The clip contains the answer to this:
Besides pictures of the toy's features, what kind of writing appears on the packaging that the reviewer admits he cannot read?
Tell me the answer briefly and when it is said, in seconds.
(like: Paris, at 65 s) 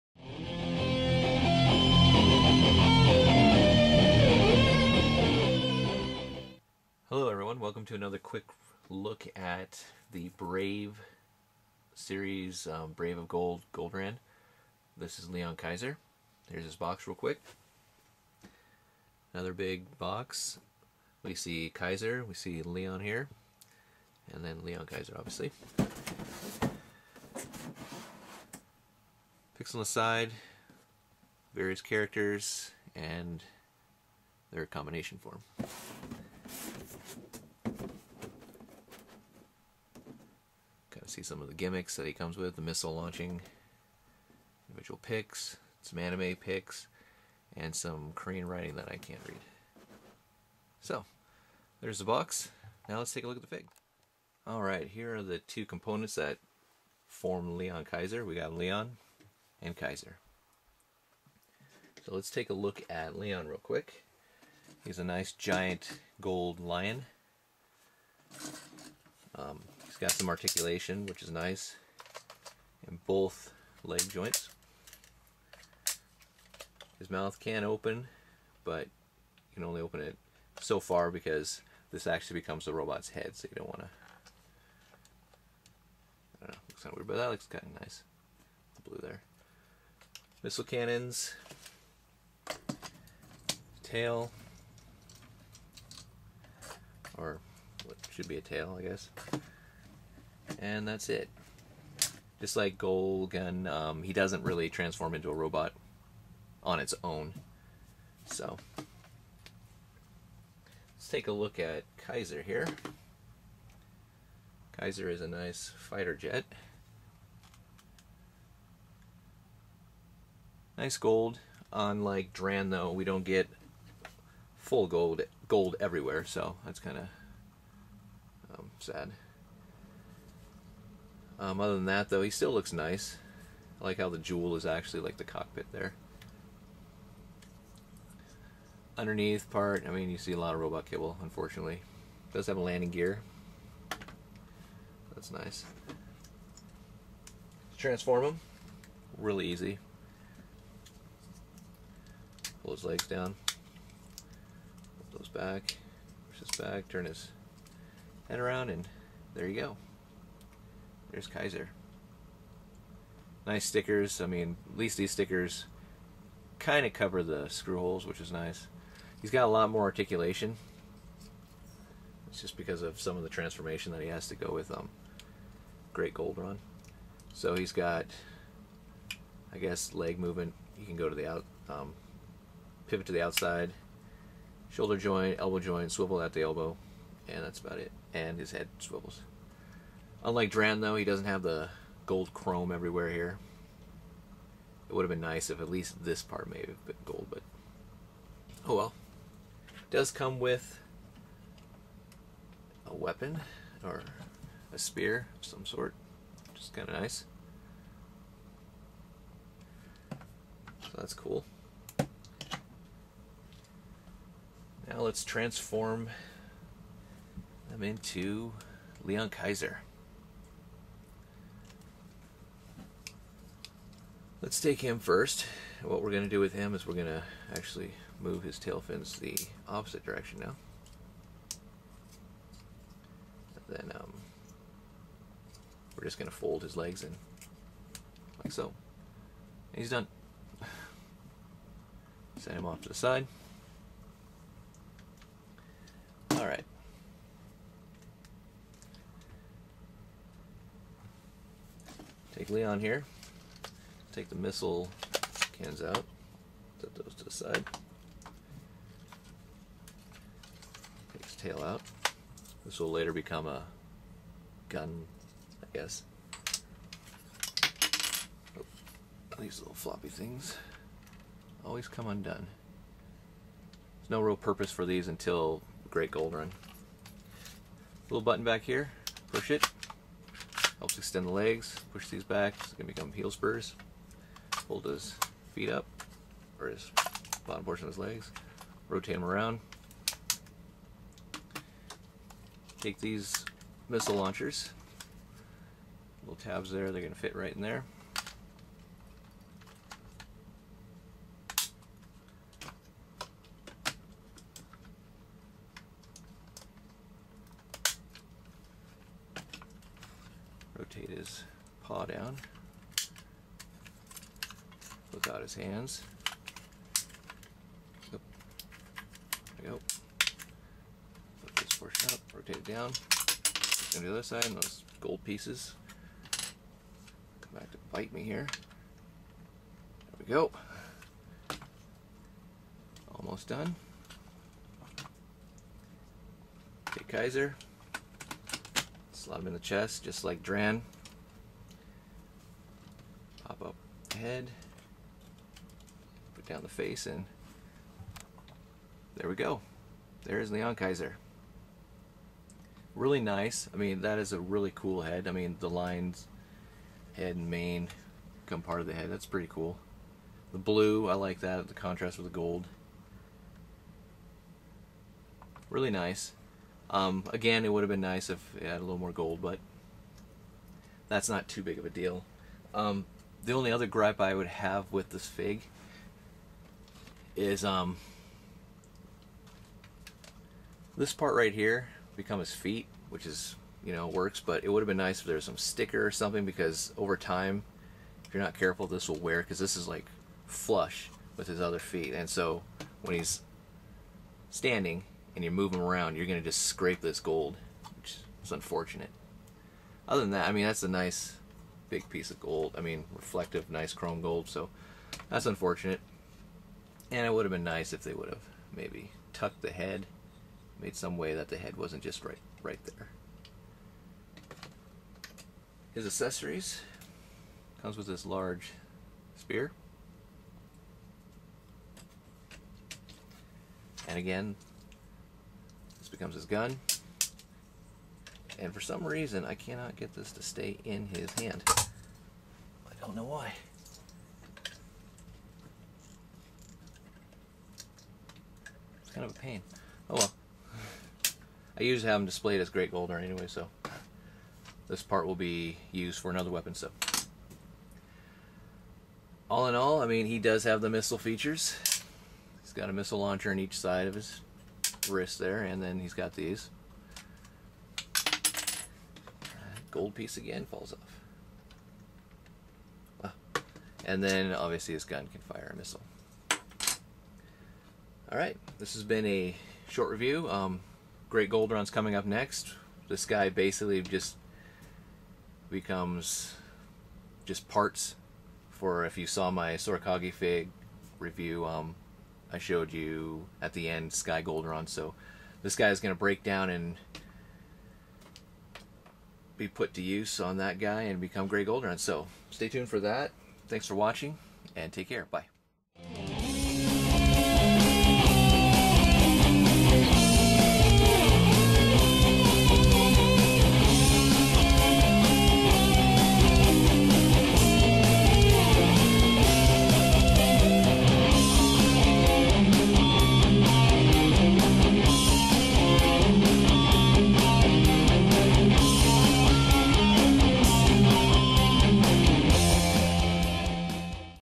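Korean writing, at 48 s.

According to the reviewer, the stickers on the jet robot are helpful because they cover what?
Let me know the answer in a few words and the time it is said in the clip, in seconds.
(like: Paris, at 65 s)
the screw holes, at 167 s.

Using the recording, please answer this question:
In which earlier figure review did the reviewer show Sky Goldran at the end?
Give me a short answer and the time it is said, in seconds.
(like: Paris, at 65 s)
Sora-Kage, at 479 s.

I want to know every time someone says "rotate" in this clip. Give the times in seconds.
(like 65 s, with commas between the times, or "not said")
288 s, 310 s, 322 s.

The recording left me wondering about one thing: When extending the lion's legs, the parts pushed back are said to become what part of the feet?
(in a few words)
heel spurs.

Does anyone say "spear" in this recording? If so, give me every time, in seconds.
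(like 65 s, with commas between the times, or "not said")
204 s, 419 s.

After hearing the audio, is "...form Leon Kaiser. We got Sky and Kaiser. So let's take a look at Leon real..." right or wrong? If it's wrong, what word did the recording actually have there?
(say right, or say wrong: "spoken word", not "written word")
wrong: "Leon", not "Sky".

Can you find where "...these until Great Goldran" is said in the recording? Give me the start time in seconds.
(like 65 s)
274 s.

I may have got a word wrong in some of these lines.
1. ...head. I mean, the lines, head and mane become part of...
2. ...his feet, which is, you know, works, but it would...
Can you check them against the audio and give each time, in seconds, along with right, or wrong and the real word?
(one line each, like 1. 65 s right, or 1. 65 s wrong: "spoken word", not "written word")
1. 355 s right
2. 382 s right.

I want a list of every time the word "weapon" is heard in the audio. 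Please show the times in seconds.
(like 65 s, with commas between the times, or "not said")
202 s, 446 s.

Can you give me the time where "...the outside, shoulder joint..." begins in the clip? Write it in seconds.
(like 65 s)
183 s.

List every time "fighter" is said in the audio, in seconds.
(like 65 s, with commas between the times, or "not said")
115 s.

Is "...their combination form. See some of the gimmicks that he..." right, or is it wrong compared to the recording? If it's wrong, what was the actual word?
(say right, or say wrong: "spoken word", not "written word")
right.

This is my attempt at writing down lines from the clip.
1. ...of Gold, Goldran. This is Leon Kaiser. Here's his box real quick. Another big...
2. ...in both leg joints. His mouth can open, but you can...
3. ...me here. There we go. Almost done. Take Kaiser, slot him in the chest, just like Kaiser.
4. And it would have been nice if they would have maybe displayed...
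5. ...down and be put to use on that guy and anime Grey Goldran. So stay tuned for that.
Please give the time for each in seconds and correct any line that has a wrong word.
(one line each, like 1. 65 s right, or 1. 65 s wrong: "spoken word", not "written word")
1. 13 s right
2. 72 s right
3. 328 s wrong: "Dran", not "Kaiser"
4. 407 s wrong: "tucked", not "displayed"
5. 486 s wrong: "become", not "anime".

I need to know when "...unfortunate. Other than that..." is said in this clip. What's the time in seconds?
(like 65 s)
398 s.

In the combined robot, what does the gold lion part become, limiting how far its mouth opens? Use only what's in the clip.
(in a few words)
the robot's head.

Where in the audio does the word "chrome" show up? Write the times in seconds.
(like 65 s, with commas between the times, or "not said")
192 s, 403 s.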